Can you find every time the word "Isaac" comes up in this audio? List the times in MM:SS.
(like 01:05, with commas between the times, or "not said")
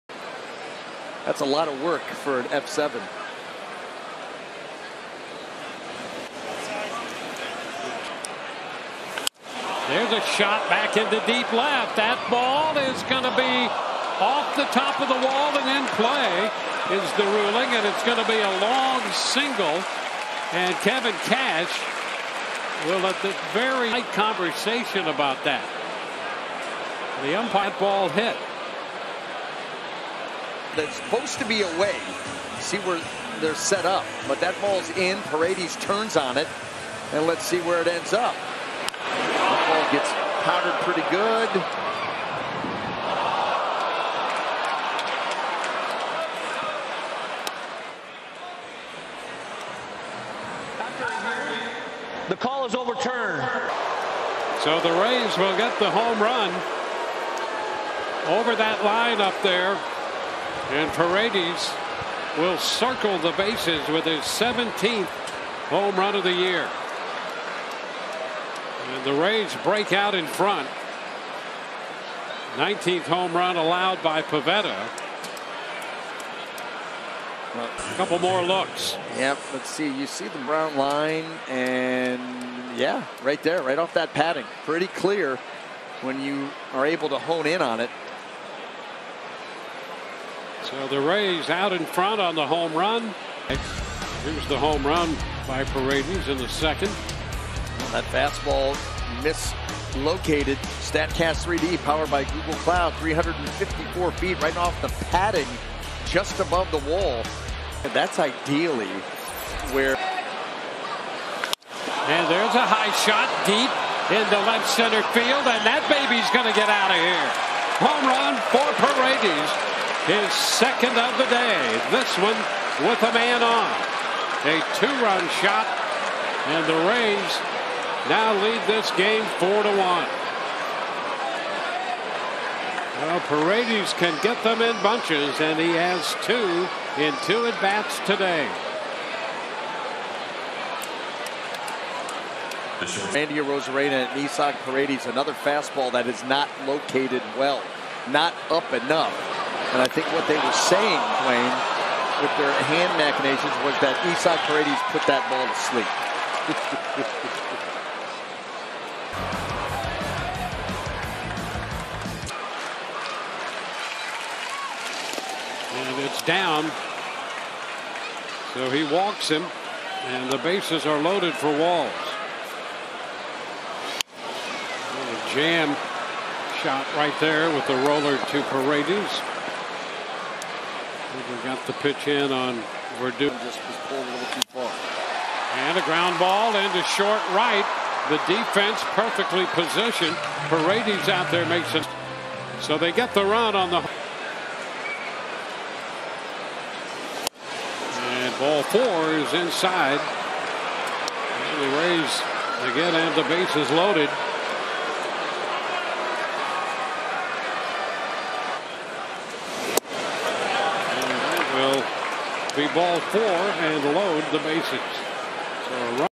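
02:24, 02:34.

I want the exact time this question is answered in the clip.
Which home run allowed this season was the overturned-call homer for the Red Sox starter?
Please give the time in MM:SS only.
01:12.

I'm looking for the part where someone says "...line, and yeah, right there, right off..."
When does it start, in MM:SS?
01:20.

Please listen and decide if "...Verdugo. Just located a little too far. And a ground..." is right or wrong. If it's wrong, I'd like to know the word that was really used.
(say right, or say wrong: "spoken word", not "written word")
wrong: "pulled", not "located".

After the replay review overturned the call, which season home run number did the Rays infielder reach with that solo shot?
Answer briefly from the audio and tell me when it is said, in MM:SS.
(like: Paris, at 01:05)
17th, at 01:04.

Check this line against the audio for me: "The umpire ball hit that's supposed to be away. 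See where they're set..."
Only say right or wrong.
right.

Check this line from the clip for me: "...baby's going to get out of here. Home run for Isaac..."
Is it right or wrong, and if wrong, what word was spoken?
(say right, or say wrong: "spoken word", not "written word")
wrong: "Paredes", not "Isaac".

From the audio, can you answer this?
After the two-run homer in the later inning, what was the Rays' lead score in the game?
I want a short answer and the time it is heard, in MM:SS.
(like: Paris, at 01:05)
4 to 1, at 02:09.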